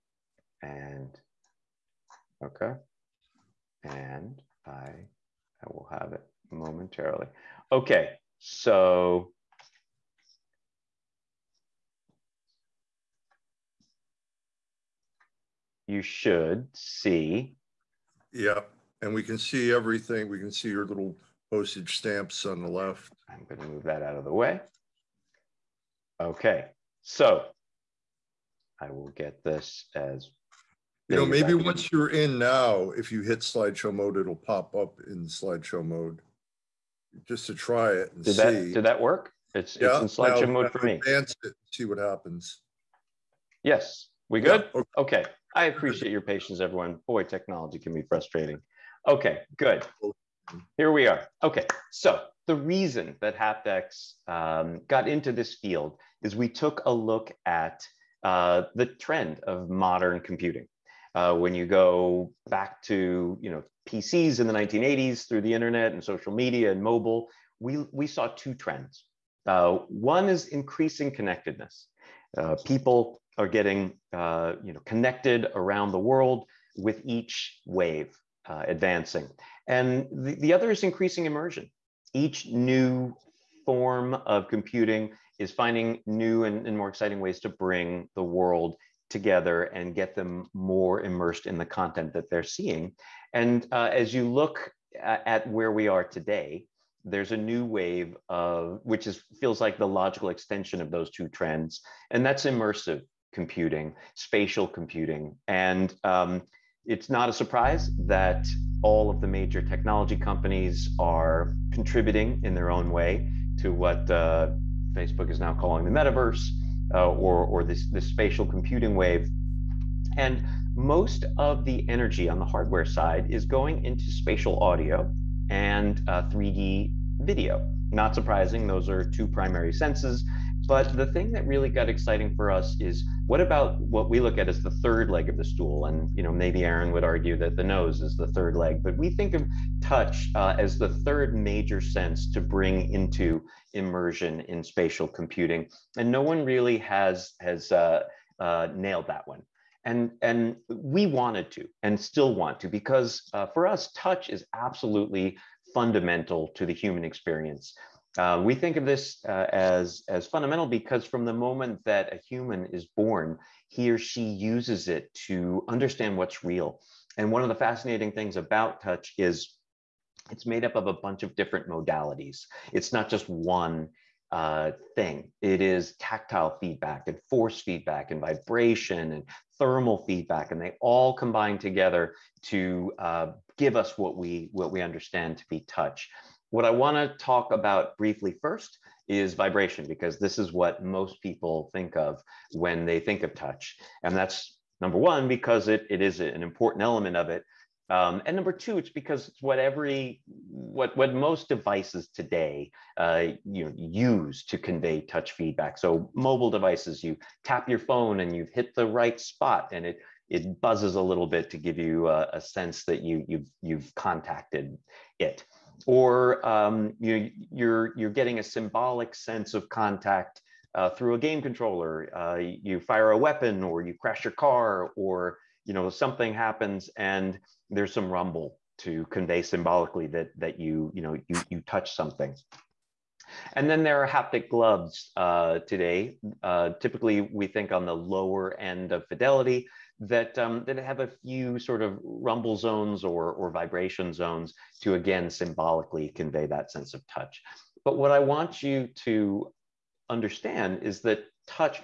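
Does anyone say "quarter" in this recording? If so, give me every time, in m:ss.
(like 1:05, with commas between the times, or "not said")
not said.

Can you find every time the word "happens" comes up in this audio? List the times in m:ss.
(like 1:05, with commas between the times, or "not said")
0:41, 3:46.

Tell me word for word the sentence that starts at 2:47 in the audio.
And one of the fascinating things about touch is it's made up of a bunch of different modalities.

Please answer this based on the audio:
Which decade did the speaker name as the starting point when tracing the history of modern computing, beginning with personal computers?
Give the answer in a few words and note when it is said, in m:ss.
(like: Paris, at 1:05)
1980s, at 1:04.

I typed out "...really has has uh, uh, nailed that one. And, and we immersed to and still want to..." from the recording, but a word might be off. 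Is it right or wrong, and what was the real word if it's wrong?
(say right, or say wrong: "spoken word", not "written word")
wrong: "wanted", not "immersed".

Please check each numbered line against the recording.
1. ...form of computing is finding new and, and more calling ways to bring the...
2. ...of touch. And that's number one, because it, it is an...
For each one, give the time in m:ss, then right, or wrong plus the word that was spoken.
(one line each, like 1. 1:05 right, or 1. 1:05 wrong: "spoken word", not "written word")
1. 1:23 wrong: "exciting", not "calling"
2. 3:13 right.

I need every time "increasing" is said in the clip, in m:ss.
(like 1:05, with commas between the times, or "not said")
1:10, 1:20.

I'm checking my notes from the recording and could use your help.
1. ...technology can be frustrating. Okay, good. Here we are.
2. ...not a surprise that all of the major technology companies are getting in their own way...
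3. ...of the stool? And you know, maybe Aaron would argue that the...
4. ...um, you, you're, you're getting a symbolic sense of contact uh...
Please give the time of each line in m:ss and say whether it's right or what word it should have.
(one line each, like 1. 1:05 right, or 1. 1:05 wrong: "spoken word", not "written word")
1. 0:47 right
2. 1:47 wrong: "contributing", not "getting"
3. 2:15 right
4. 3:36 right.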